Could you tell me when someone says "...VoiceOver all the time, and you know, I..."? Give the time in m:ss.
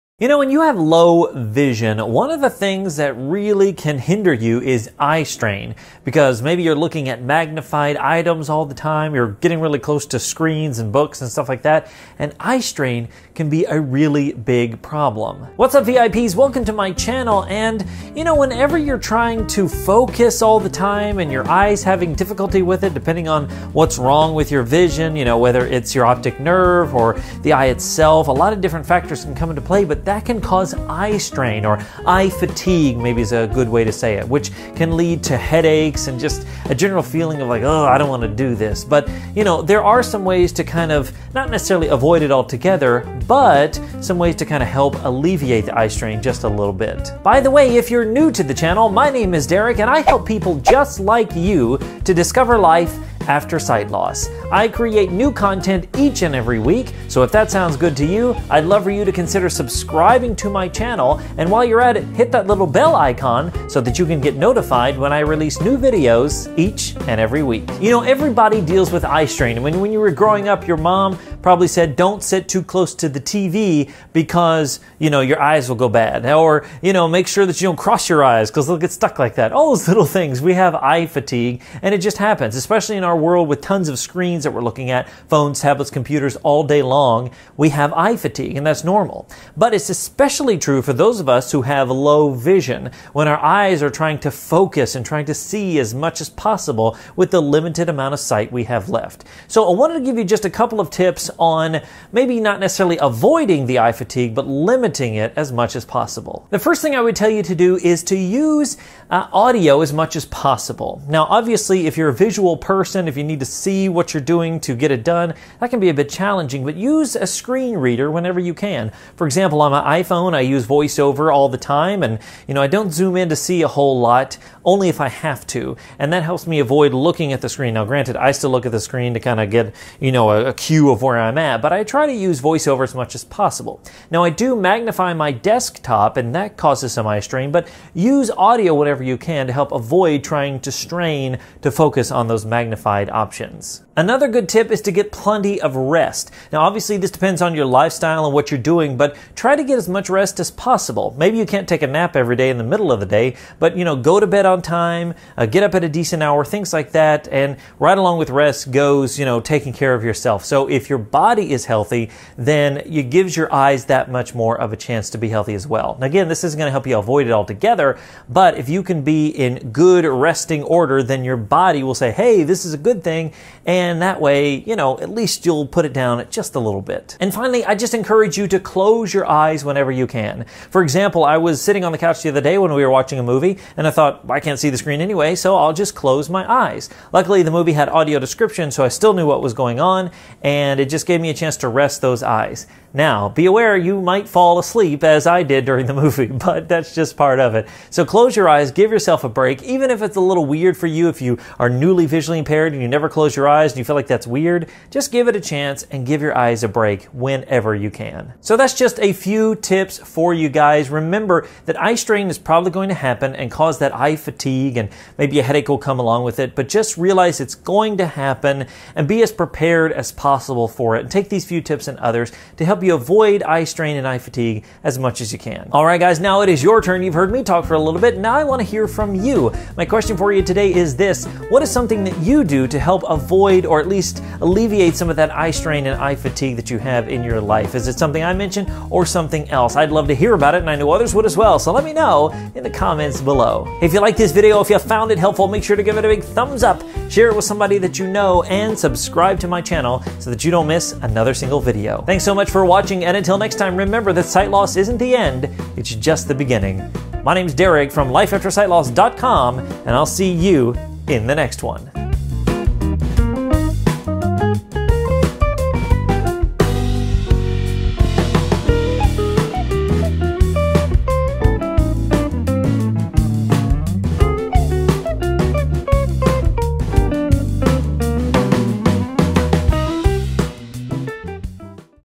2:00.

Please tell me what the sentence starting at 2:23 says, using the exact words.
Another good tip is to get plenty of rest.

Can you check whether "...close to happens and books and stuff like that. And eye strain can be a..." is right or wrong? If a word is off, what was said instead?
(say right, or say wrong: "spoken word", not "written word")
wrong: "screens", not "happens".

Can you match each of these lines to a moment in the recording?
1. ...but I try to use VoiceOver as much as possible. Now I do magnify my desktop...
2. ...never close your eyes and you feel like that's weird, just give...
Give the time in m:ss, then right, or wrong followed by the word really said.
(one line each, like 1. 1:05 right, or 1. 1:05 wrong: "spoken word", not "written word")
1. 2:11 right
2. 3:22 right.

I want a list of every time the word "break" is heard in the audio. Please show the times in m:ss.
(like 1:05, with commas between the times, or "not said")
3:19, 3:26.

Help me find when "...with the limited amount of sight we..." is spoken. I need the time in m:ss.
1:37.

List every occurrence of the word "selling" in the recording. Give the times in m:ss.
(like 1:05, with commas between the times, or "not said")
not said.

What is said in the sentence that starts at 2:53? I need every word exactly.
And that way, you know, at least you'll put it down just a little bit.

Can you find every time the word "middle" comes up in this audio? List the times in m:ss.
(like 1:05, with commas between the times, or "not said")
2:32.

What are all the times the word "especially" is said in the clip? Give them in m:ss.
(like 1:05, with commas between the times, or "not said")
1:22, 1:29.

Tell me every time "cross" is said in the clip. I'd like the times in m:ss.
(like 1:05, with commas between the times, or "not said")
1:17.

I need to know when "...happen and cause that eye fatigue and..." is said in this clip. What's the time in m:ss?
3:32.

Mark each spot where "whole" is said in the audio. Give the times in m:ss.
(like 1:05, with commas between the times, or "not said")
2:03.